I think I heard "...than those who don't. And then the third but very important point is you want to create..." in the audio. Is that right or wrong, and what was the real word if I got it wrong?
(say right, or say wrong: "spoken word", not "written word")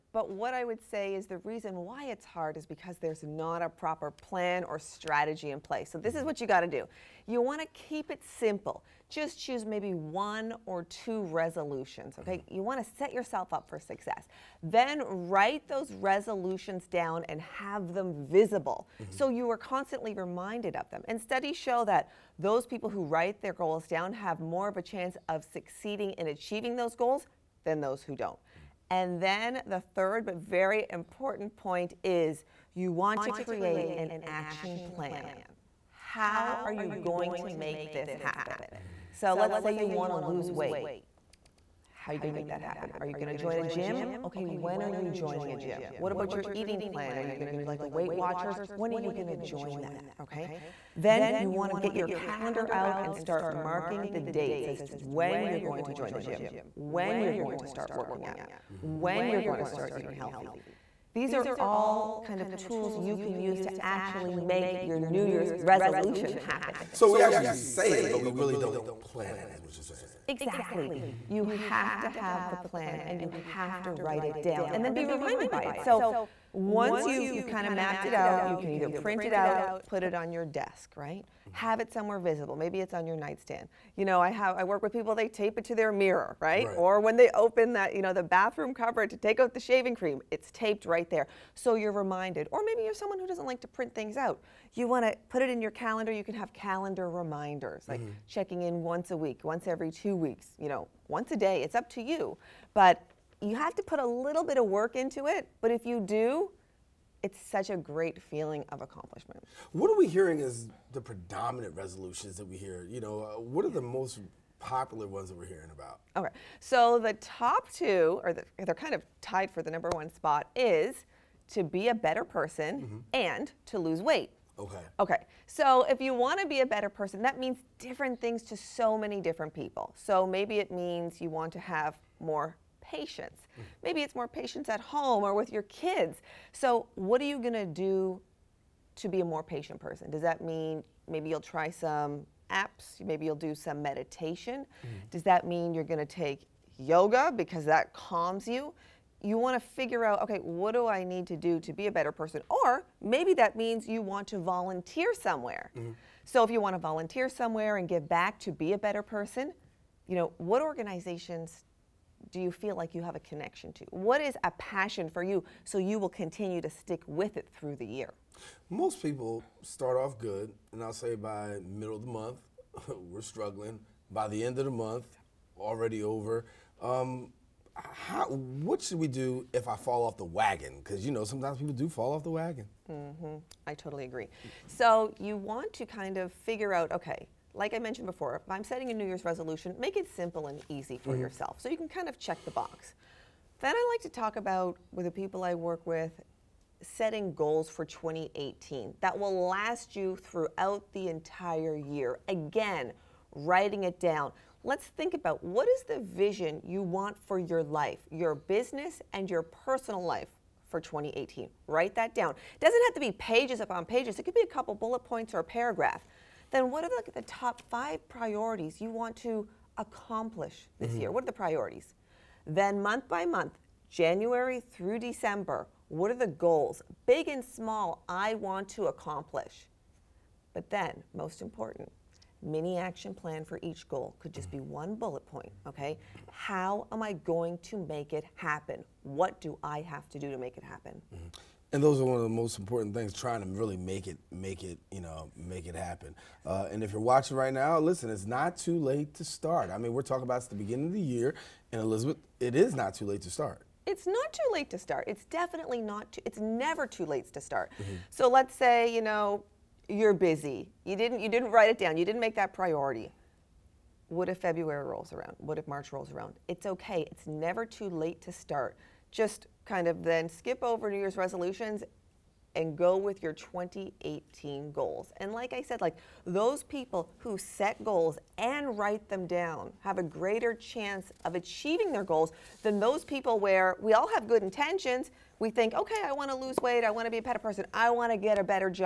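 right.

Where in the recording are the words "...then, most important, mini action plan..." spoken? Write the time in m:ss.
3:50.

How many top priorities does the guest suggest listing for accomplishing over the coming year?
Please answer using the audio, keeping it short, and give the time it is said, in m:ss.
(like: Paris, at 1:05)
5, at 3:37.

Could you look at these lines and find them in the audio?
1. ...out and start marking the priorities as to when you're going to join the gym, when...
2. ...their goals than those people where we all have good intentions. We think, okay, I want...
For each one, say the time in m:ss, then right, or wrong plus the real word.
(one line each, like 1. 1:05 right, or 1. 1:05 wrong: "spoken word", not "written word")
1. 0:52 wrong: "dates", not "priorities"
2. 4:41 right.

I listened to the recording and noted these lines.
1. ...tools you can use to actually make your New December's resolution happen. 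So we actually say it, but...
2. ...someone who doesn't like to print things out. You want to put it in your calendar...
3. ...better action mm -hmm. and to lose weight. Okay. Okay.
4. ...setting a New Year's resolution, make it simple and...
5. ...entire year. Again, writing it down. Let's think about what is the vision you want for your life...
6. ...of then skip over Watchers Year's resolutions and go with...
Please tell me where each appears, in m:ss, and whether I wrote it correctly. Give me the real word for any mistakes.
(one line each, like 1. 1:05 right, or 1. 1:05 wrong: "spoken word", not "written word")
1. 1:02 wrong: "Year", not "December"
2. 1:32 right
3. 2:02 wrong: "person", not "action"
4. 3:08 right
5. 3:21 right
6. 4:29 wrong: "New", not "Watchers".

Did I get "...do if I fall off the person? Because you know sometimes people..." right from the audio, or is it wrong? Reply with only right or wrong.
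wrong.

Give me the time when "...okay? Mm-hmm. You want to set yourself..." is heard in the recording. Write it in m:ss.
0:12.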